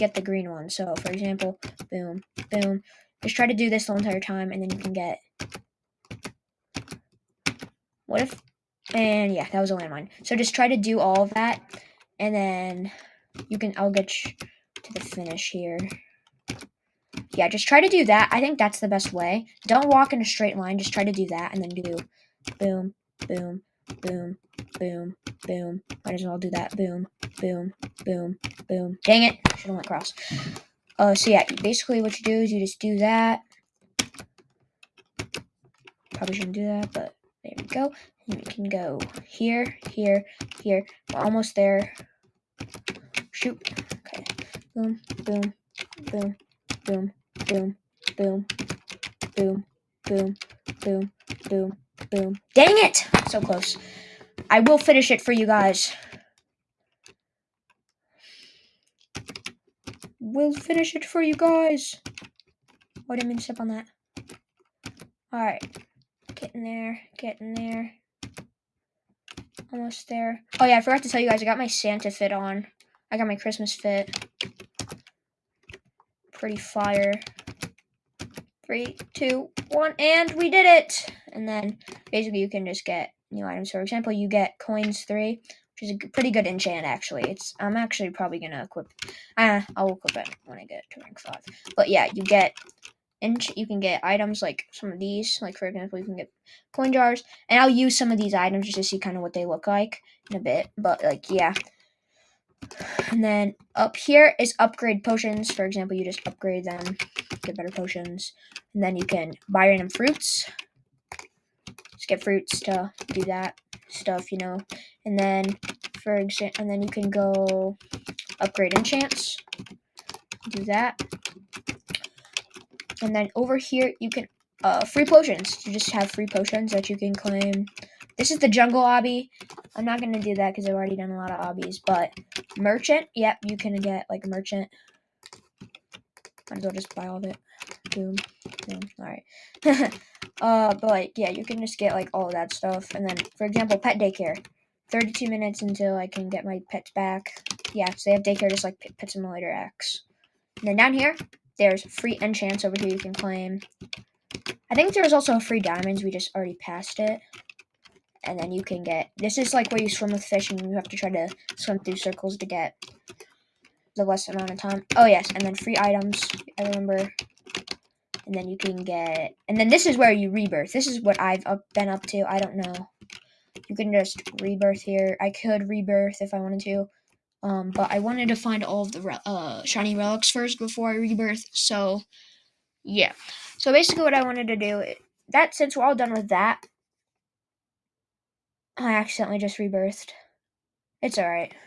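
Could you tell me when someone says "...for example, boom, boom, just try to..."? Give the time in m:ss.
0:00.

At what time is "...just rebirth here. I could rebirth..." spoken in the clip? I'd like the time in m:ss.
2:53.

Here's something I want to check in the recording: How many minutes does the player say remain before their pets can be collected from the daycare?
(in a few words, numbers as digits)
32.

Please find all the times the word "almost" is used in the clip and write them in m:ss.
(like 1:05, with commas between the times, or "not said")
0:41, 1:09.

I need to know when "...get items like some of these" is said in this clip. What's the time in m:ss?
1:33.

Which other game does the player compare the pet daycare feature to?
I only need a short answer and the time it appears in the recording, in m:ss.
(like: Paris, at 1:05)
Pet Simulator X, at 2:28.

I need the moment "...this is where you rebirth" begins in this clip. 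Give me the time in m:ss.
2:49.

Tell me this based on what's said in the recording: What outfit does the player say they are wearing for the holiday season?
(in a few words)
Santa fit.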